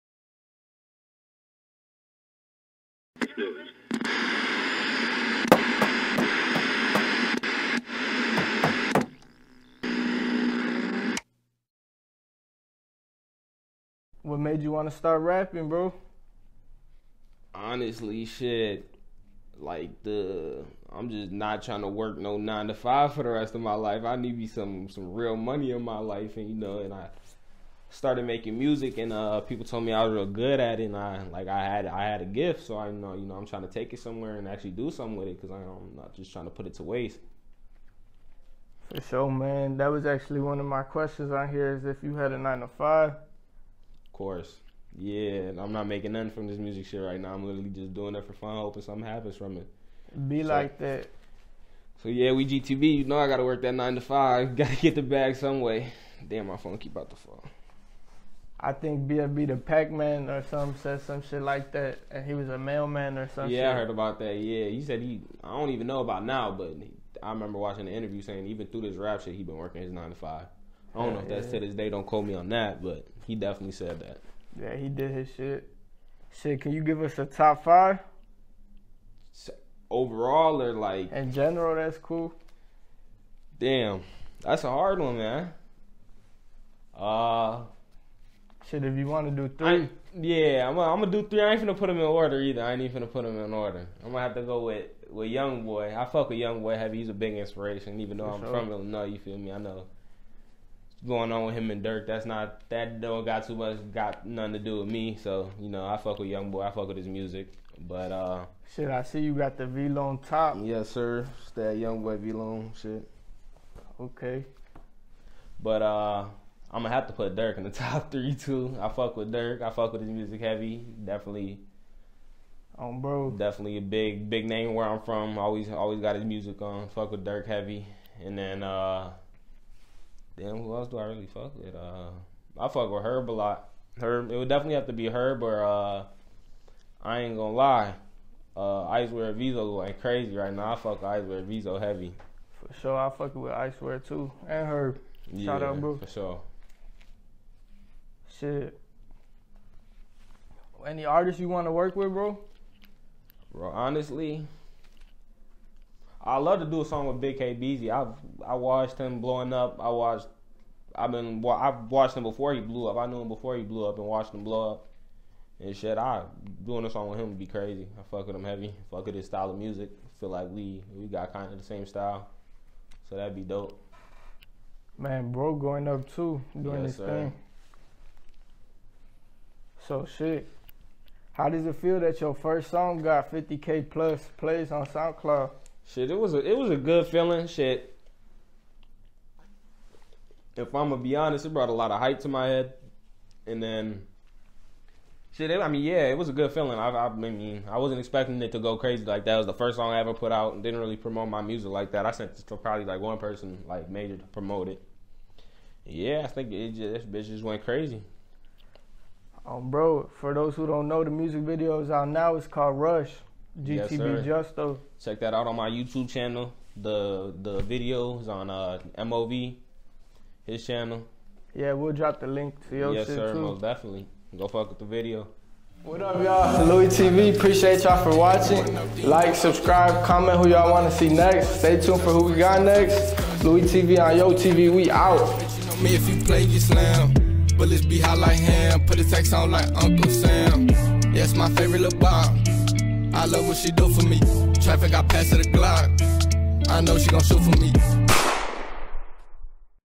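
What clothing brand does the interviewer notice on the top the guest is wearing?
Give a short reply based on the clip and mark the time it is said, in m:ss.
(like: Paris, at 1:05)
VLONE, at 1:49.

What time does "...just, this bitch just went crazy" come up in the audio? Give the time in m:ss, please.
3:26.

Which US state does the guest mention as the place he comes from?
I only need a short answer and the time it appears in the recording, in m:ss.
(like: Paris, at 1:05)
Illinois, at 1:38.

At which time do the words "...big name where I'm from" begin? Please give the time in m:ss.
2:04.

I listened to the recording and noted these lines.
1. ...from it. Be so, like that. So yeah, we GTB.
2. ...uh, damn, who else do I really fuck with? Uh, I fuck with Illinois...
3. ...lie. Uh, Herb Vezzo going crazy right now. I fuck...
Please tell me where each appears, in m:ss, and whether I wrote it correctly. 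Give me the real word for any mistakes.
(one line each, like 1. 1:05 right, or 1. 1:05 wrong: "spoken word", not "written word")
1. 0:49 right
2. 2:08 wrong: "Herb", not "Illinois"
3. 2:17 wrong: "Icewear", not "Herb".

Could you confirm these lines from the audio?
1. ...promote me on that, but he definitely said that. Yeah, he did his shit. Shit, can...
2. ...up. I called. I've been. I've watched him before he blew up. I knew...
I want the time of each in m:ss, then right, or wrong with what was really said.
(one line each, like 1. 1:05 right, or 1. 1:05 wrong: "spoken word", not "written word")
1. 1:12 wrong: "quote", not "promote"
2. 2:39 wrong: "watched", not "called".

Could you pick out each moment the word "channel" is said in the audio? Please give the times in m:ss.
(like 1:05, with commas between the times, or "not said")
3:36, 3:40.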